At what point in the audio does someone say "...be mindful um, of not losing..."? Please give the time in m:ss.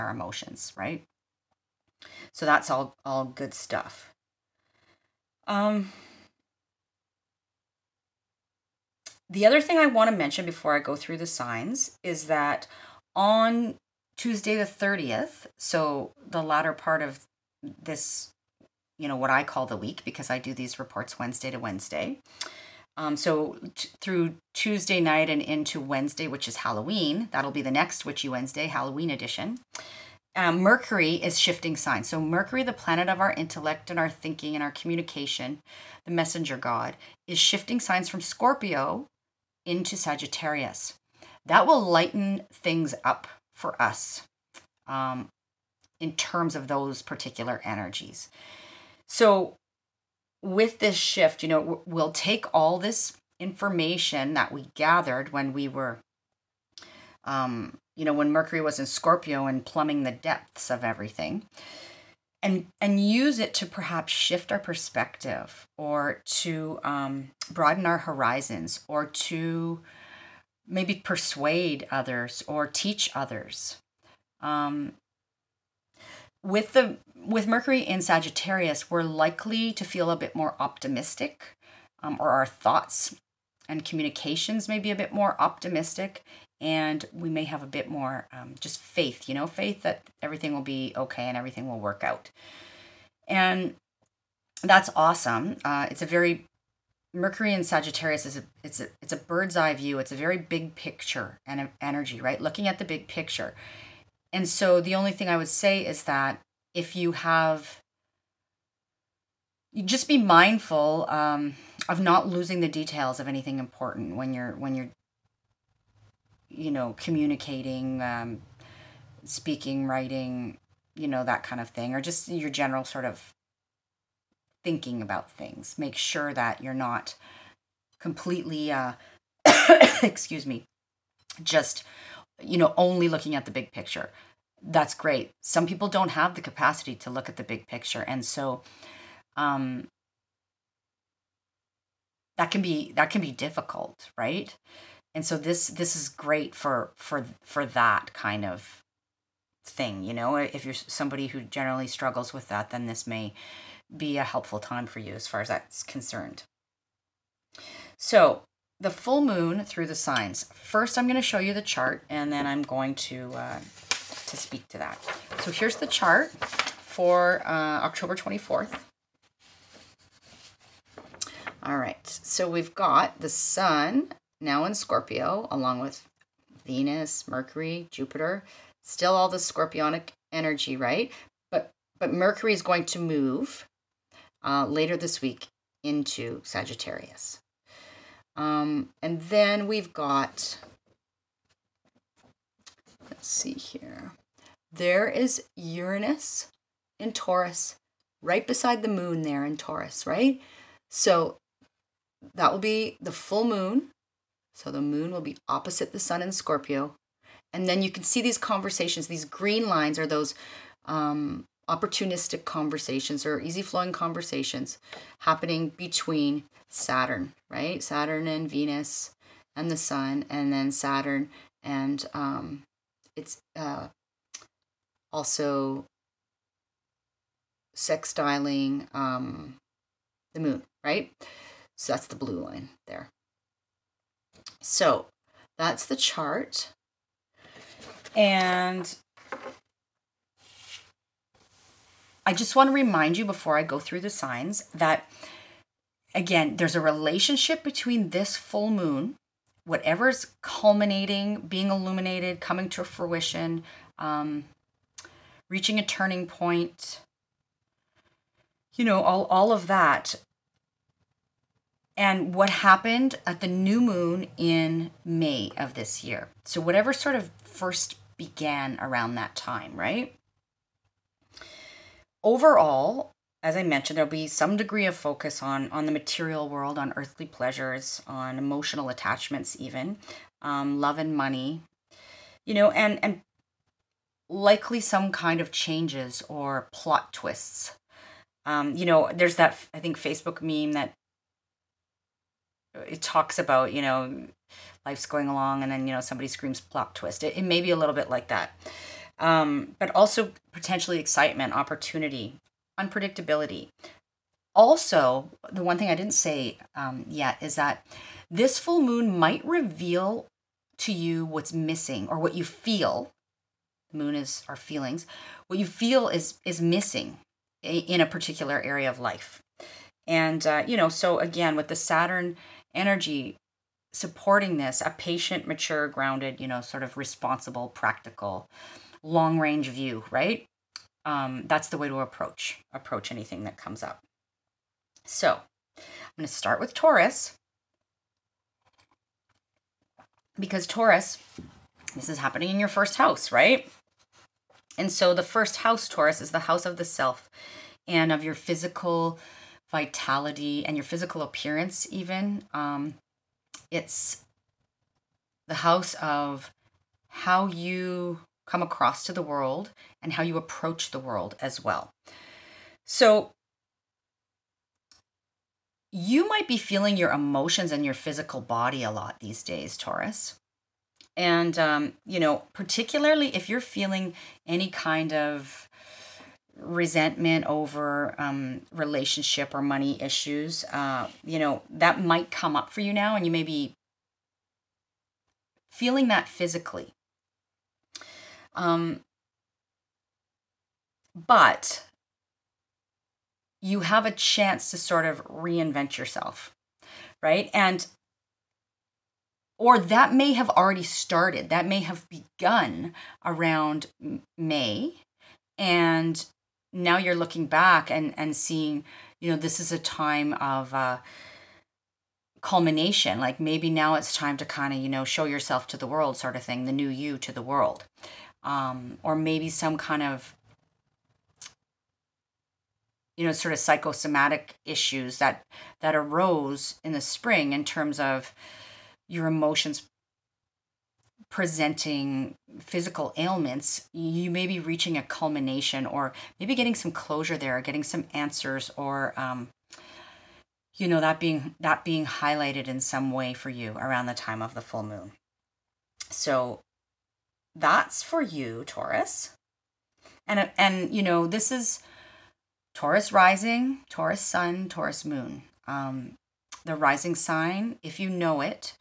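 1:50.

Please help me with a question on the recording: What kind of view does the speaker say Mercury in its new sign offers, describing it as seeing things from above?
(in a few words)
bird's eye view.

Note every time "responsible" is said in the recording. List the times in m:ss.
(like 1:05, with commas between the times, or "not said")
5:26.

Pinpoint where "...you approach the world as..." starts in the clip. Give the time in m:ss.
6:00.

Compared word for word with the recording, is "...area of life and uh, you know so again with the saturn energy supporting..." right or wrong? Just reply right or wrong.
right.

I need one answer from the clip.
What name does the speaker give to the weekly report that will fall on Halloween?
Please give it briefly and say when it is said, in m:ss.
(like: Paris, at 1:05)
Witchy Wednesday, at 0:28.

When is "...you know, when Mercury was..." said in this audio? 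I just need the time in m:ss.
0:57.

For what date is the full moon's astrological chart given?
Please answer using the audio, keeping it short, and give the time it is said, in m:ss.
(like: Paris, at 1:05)
October 24th, at 2:47.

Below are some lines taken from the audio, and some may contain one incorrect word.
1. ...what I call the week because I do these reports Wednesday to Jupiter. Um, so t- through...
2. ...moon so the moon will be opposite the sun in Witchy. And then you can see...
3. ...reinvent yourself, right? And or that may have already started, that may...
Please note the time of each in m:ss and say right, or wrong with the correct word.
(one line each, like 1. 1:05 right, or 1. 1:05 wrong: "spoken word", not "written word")
1. 0:19 wrong: "Wednesday", not "Jupiter"
2. 3:23 wrong: "Scorpio", not "Witchy"
3. 6:35 right.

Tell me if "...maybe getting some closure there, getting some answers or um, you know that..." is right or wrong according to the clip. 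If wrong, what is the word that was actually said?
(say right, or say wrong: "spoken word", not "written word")
right.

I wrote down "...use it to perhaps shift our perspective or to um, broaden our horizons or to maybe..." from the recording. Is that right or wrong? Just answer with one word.
right.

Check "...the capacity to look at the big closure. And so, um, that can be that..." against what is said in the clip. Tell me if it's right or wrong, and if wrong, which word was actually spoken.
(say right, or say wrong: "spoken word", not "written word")
wrong: "picture", not "closure".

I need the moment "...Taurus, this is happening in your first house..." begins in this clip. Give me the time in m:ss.
5:40.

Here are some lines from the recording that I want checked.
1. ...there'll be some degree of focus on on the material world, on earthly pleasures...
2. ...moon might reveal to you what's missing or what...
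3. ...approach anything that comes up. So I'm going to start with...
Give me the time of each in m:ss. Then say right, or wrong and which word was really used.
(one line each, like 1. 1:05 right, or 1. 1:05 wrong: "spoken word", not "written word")
1. 4:33 right
2. 5:08 right
3. 5:32 right.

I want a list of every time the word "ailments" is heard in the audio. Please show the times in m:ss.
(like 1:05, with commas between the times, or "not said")
7:13.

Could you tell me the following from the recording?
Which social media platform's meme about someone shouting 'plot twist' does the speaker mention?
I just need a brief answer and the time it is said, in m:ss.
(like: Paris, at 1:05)
Facebook, at 4:49.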